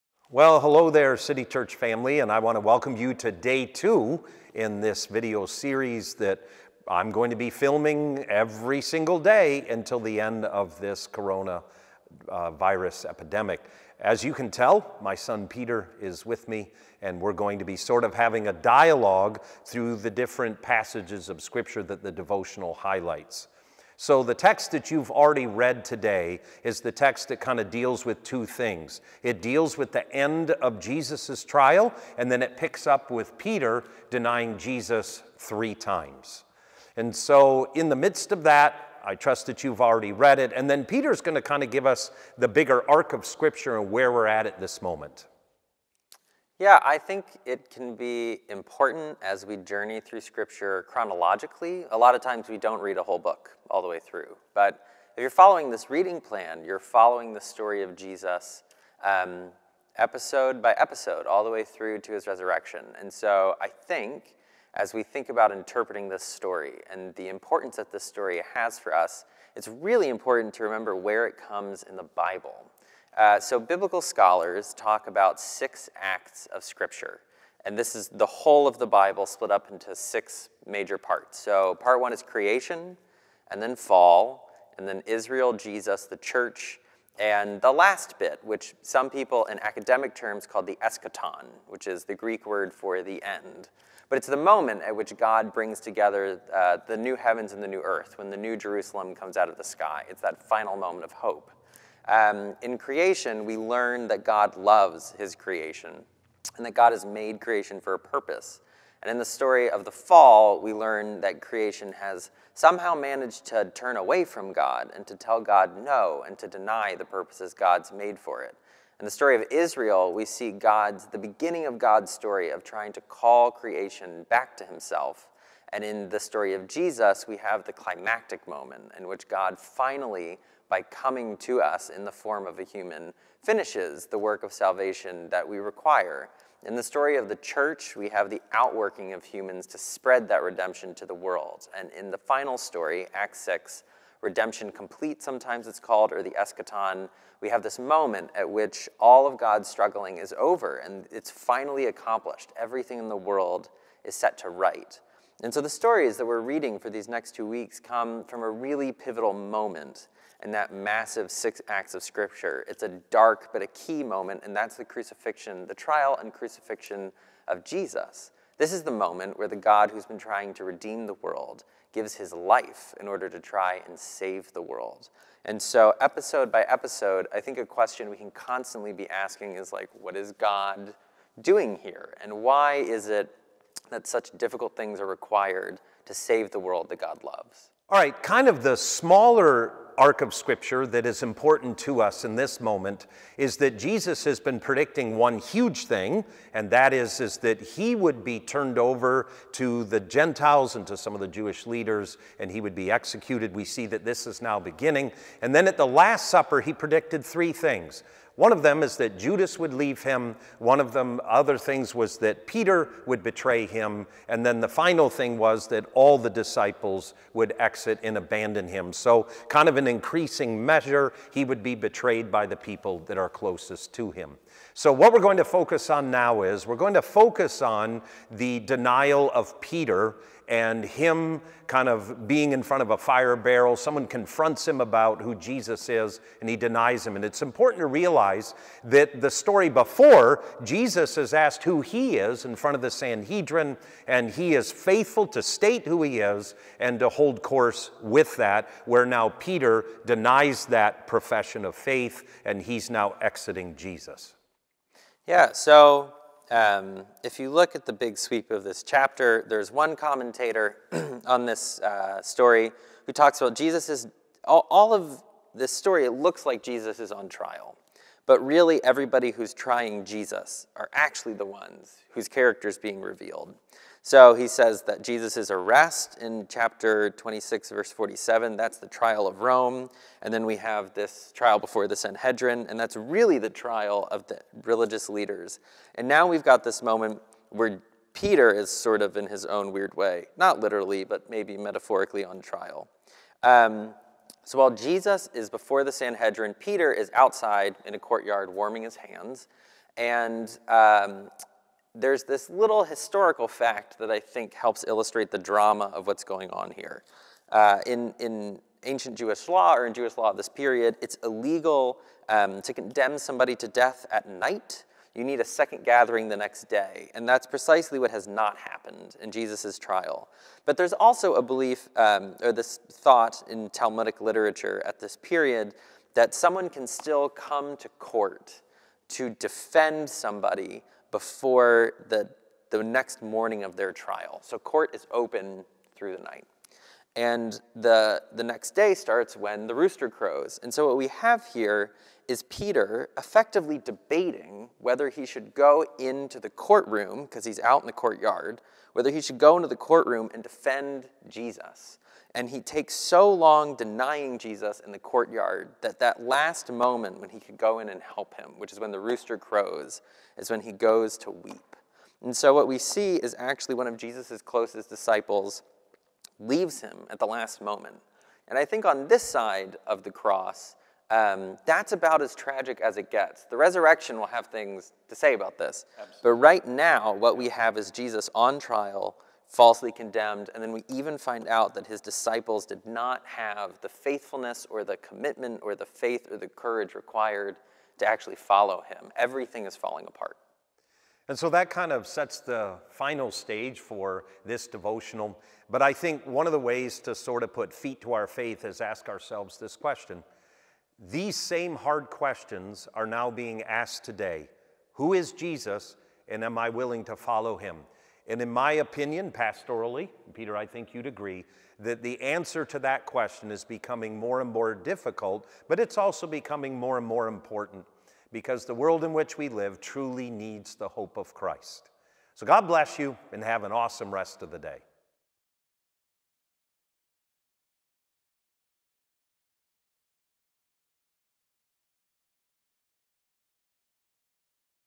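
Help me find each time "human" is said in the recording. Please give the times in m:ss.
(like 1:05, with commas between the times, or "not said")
2:12, 2:19.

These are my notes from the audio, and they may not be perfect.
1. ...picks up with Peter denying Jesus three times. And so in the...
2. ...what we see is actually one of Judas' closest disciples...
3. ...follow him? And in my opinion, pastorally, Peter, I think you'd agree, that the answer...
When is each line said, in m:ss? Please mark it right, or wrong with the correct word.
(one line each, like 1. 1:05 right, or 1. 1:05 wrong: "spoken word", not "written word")
1. 0:32 right
2. 6:02 wrong: "Jesus", not "Judas"
3. 6:47 right.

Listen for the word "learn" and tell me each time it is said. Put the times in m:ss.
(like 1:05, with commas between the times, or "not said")
1:43, 1:50.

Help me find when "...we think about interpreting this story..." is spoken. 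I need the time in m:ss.
1:04.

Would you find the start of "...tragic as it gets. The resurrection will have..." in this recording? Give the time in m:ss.
6:12.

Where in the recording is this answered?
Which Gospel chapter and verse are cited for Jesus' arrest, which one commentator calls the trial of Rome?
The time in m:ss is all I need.
4:36.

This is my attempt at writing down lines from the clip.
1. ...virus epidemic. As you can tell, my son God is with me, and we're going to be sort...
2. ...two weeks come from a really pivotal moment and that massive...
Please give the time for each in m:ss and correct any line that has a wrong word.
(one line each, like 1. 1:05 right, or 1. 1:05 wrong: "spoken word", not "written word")
1. 0:12 wrong: "Peter", not "God"
2. 2:37 right.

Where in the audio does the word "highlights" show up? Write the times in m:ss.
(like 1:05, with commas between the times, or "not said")
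0:22.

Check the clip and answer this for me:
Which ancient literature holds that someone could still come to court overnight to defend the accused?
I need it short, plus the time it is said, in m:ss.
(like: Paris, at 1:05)
Talmudic literature, at 5:23.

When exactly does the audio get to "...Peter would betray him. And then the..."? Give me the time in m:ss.
3:32.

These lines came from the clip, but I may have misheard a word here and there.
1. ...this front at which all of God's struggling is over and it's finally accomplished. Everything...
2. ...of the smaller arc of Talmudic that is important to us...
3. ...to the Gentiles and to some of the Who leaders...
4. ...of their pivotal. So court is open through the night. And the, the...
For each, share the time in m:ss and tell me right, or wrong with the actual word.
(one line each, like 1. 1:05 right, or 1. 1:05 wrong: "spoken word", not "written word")
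1. 2:27 wrong: "moment", not "front"
2. 3:08 wrong: "Scripture", not "Talmudic"
3. 3:19 wrong: "Jewish", not "Who"
4. 5:33 wrong: "trial", not "pivotal".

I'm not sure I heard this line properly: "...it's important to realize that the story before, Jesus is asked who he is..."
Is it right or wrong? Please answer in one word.
right.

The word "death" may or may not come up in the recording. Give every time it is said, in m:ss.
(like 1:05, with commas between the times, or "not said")
5:13.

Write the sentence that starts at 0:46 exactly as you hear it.
Yeah, I think it can be important as we journey through scripture chronologically.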